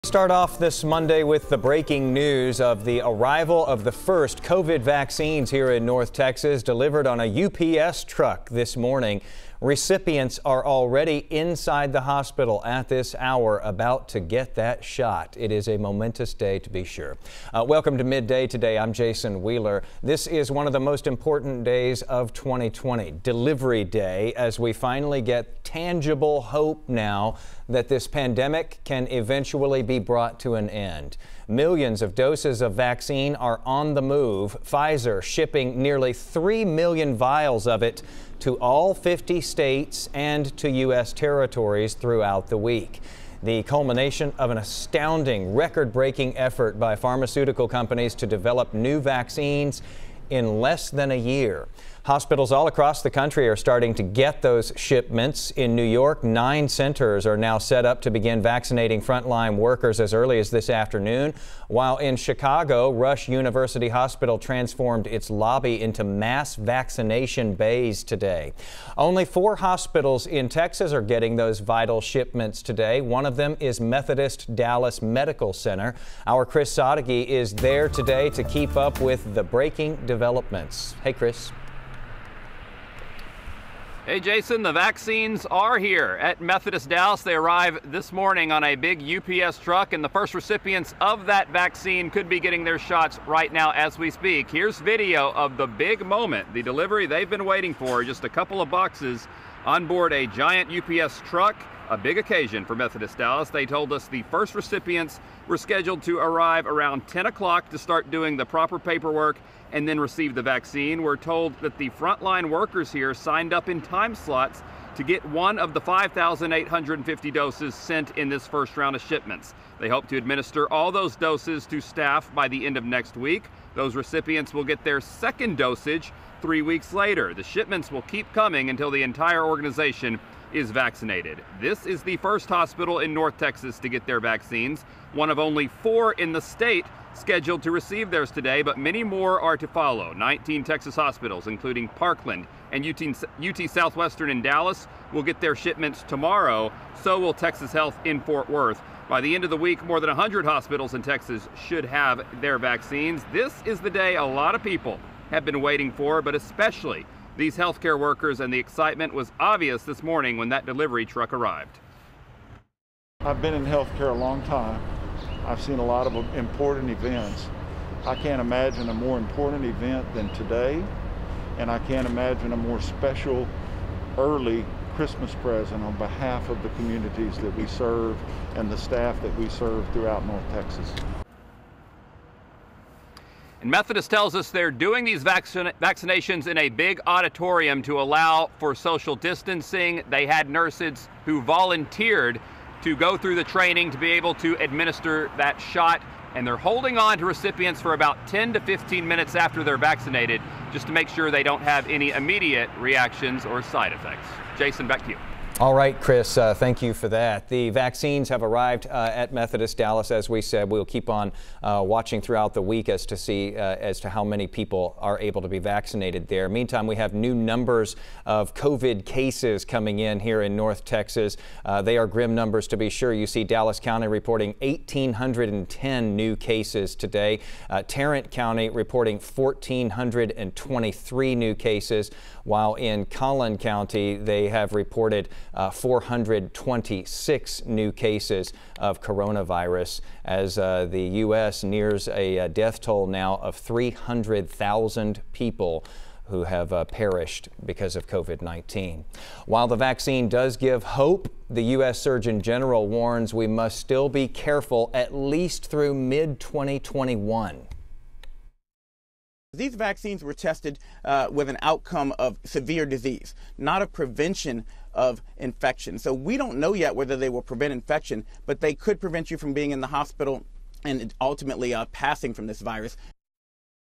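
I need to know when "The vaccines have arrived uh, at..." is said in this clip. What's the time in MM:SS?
03:27.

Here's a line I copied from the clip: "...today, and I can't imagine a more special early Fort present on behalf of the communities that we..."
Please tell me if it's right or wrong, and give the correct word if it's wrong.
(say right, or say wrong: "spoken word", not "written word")
wrong: "Christmas", not "Fort".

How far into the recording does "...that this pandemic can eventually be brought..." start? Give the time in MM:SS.
00:27.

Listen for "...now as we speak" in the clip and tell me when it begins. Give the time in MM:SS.
01:33.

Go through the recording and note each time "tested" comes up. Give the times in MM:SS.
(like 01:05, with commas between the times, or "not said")
04:20.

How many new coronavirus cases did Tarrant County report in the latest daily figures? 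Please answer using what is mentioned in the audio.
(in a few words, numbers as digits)
1,423.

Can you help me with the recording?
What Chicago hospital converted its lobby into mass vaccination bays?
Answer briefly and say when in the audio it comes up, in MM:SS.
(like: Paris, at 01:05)
Rush University Hospital, at 01:02.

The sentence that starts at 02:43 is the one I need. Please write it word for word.
I've been in healthcare a long time I've seen a lot of important events.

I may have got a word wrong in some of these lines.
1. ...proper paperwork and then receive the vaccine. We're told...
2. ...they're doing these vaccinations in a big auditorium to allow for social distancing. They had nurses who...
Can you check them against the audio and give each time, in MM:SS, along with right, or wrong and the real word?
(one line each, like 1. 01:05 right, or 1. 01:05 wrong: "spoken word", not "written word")
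1. 01:48 right
2. 03:04 right.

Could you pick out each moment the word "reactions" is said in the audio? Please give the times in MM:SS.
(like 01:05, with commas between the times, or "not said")
03:22.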